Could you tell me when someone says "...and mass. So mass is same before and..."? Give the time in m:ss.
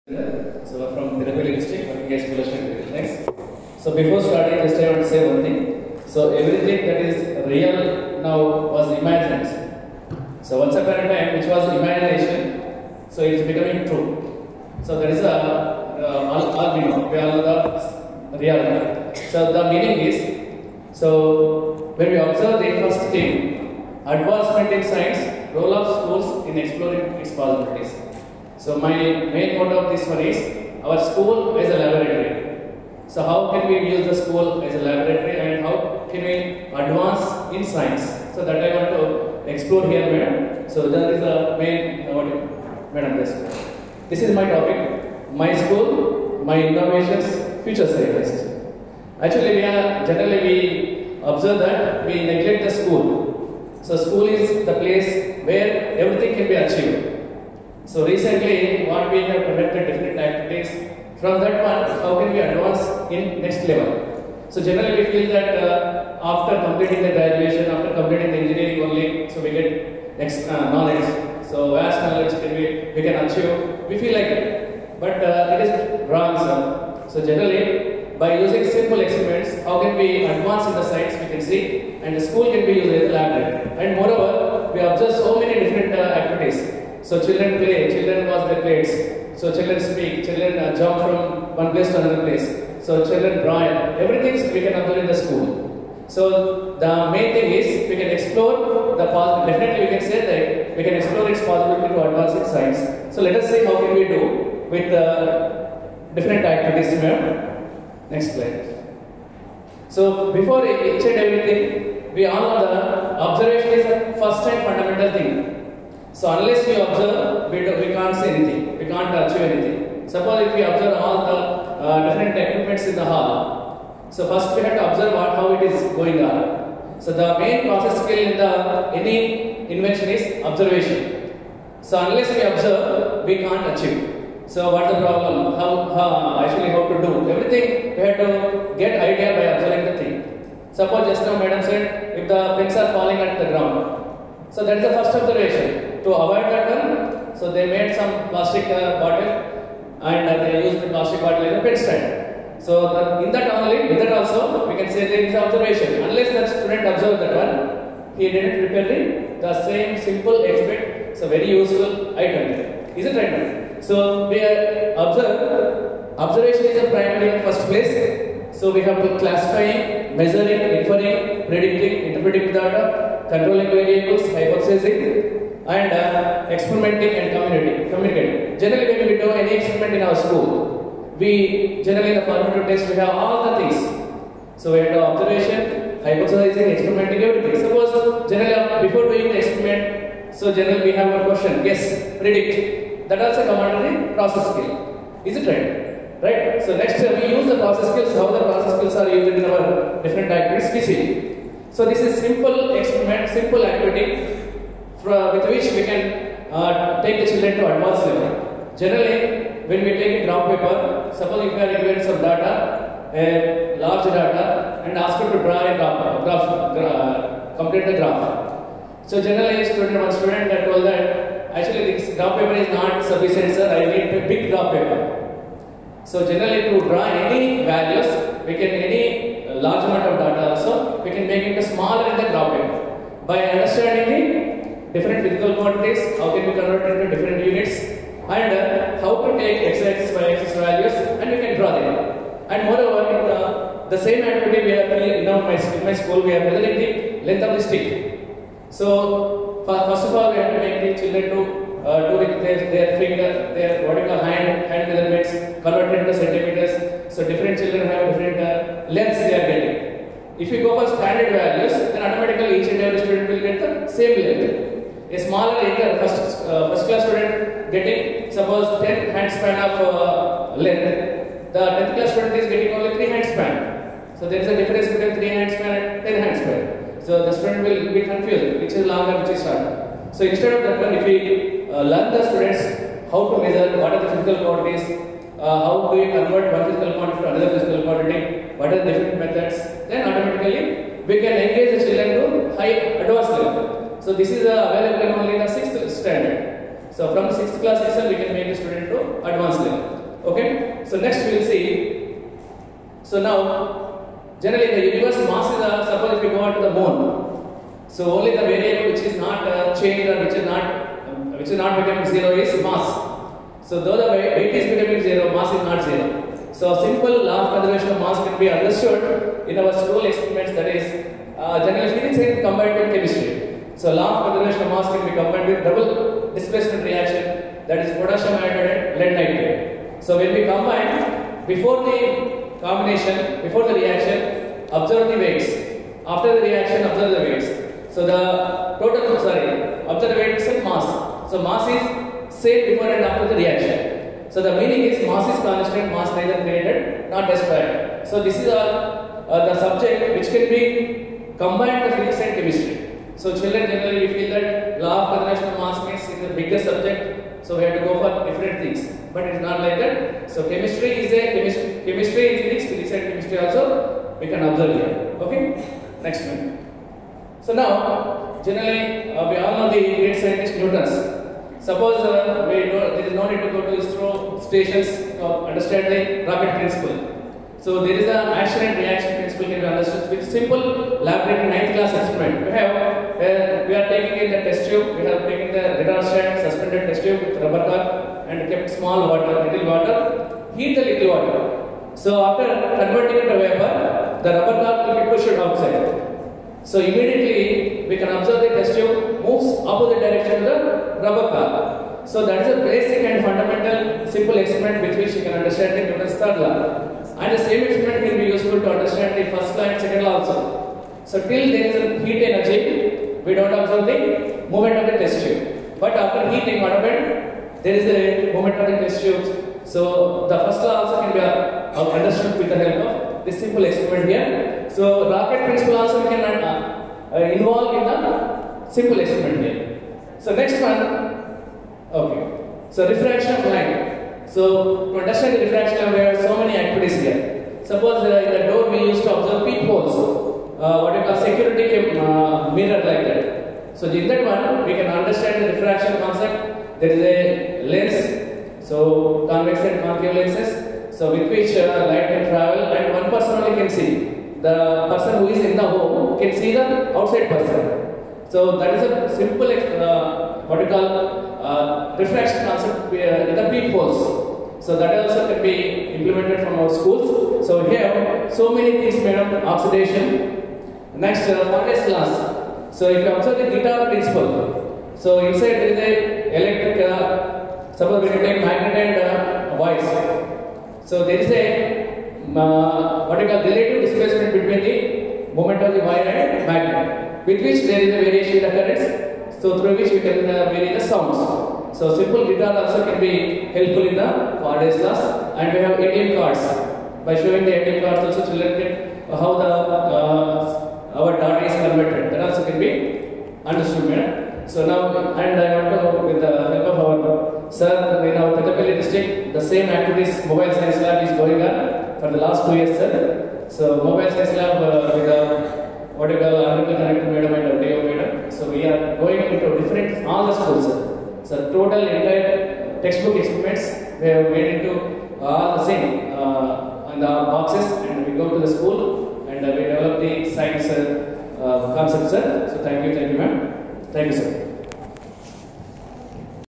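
5:40.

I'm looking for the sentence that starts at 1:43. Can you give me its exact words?
So let us see how can we do with the uh, different activities here.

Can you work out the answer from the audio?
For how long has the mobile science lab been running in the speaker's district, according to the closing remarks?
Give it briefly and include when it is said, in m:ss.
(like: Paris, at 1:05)
2 years, at 8:32.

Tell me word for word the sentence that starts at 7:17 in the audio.
Suppose make a uh, mirror like that.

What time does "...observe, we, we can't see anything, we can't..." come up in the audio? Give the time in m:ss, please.
1:56.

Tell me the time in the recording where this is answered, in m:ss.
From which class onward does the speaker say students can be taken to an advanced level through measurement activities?
4:57.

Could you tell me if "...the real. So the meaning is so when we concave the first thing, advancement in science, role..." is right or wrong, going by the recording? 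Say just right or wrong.
wrong.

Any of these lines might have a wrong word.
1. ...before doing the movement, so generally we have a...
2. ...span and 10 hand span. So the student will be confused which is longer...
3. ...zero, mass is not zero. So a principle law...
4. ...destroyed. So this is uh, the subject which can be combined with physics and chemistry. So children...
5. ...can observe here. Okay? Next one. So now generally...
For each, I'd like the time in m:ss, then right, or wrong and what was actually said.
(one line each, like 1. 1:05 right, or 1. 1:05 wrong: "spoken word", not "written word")
1. 3:08 wrong: "experiment", not "movement"
2. 4:35 right
3. 5:15 wrong: "simple", not "principle"
4. 5:47 right
5. 6:04 right.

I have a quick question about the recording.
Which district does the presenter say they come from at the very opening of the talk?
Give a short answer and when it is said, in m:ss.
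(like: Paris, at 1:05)
Tirupati, at 0:01.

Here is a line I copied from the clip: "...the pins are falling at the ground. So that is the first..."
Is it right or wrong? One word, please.
right.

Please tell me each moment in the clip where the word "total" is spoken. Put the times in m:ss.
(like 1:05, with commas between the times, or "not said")
5:38, 8:41.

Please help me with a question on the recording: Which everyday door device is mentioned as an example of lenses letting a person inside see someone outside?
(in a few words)
peepholes.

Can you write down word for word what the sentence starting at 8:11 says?
So simple guitar also can be helpful in the Faraday's laws, and we have ATM cards.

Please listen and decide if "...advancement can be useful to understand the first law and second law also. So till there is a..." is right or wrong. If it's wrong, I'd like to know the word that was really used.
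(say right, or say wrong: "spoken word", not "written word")
wrong: "experiment", not "advancement".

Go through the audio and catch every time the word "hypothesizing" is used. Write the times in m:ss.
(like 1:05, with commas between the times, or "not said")
2:54, 3:06.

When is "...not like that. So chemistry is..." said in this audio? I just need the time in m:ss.
5:59.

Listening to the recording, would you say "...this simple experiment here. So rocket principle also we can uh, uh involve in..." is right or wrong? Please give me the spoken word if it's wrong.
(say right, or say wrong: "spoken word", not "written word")
right.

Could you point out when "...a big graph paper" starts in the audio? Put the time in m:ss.
3:44.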